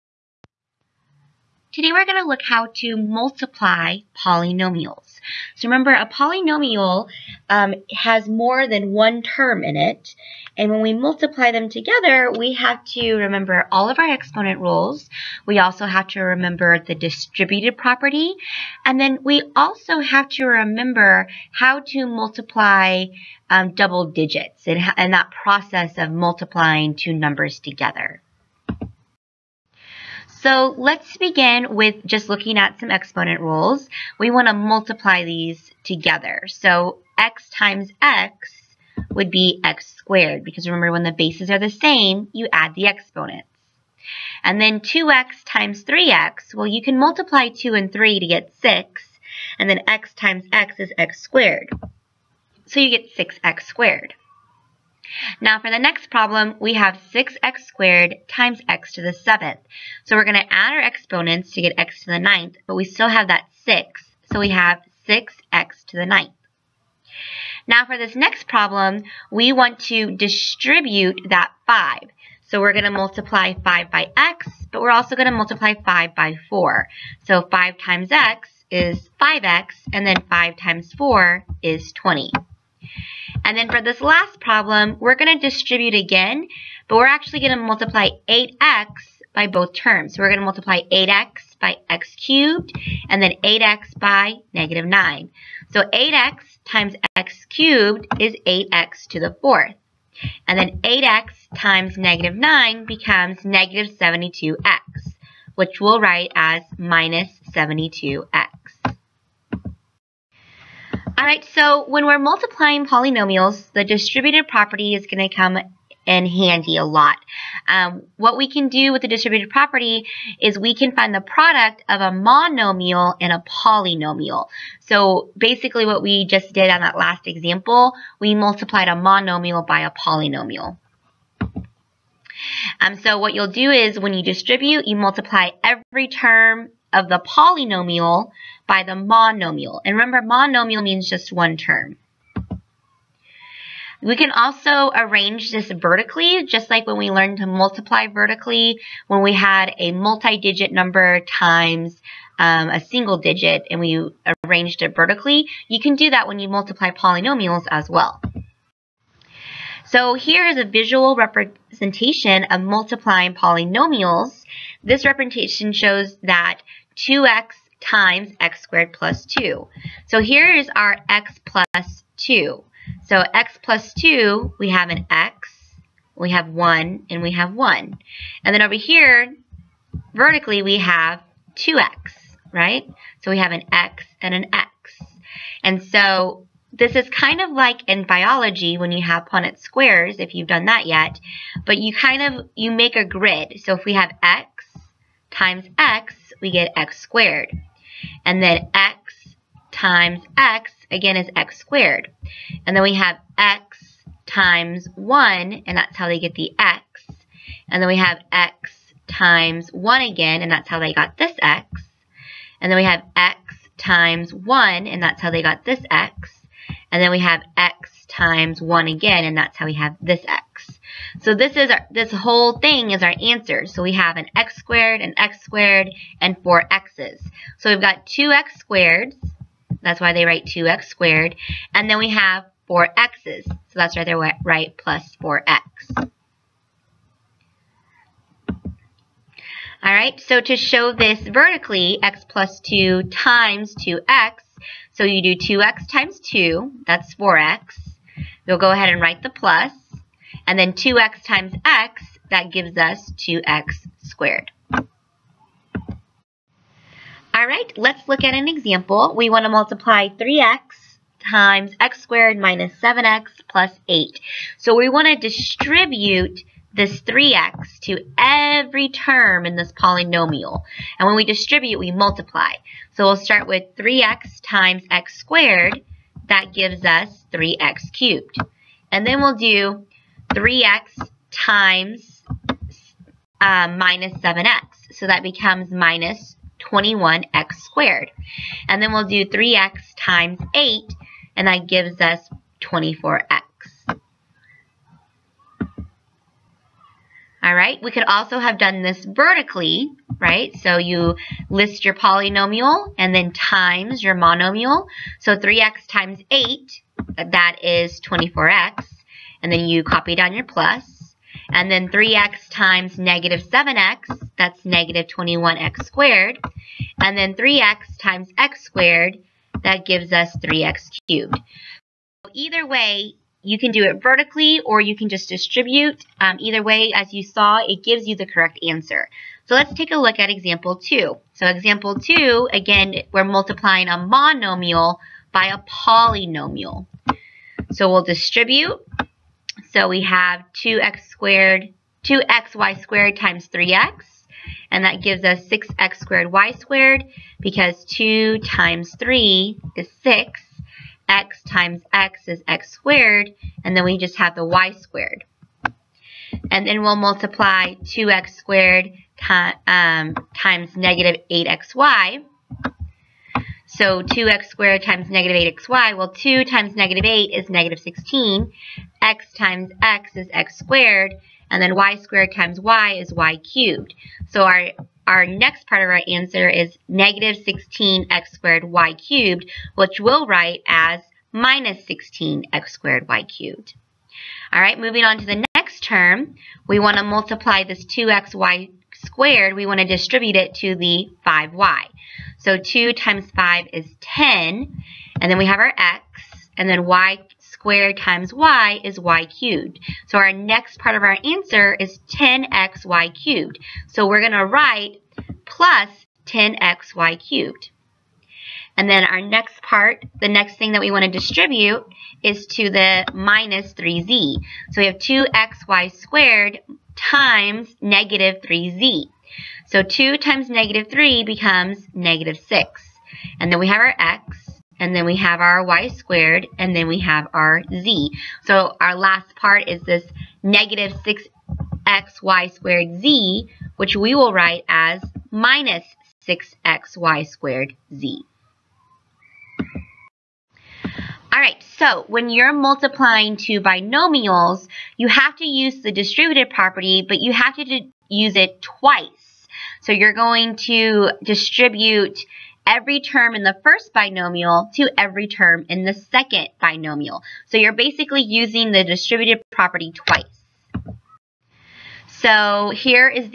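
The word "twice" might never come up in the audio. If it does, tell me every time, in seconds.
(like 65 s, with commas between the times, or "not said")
448 s, 459 s.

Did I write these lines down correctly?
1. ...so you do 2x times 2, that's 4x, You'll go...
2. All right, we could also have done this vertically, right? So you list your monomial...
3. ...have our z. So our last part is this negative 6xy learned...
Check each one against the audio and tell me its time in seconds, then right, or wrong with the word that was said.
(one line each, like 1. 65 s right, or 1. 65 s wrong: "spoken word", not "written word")
1. 244 s right
2. 297 s wrong: "polynomial", not "monomial"
3. 426 s wrong: "squared", not "learned".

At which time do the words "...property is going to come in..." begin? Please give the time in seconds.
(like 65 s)
114 s.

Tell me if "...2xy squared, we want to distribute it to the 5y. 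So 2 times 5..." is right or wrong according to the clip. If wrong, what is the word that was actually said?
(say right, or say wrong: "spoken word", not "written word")
right.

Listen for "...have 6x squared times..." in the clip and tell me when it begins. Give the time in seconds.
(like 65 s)
56 s.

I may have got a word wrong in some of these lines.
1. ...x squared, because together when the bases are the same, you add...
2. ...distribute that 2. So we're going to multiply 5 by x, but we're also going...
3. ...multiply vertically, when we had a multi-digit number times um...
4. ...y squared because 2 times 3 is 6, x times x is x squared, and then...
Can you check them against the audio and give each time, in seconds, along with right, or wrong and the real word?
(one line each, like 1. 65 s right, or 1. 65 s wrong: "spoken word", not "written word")
1. 39 s wrong: "remember", not "together"
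2. 70 s wrong: "5", not "2"
3. 147 s right
4. 346 s right.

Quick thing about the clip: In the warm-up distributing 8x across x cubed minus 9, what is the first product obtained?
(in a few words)
8x^4.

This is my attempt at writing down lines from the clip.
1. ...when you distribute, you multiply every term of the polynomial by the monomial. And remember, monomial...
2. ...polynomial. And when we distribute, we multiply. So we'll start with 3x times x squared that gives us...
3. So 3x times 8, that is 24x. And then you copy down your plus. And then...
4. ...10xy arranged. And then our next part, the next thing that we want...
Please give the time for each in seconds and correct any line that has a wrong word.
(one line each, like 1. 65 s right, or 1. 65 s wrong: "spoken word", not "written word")
1. 133 s right
2. 269 s right
3. 305 s right
4. 406 s wrong: "cubed", not "arranged".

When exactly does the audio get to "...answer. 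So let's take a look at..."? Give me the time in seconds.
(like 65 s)
328 s.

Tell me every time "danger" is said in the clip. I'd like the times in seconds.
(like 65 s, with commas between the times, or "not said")
not said.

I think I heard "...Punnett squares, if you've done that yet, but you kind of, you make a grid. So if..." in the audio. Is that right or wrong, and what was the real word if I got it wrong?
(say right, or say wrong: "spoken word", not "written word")
right.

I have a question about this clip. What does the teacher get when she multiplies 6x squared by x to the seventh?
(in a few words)
6x^9.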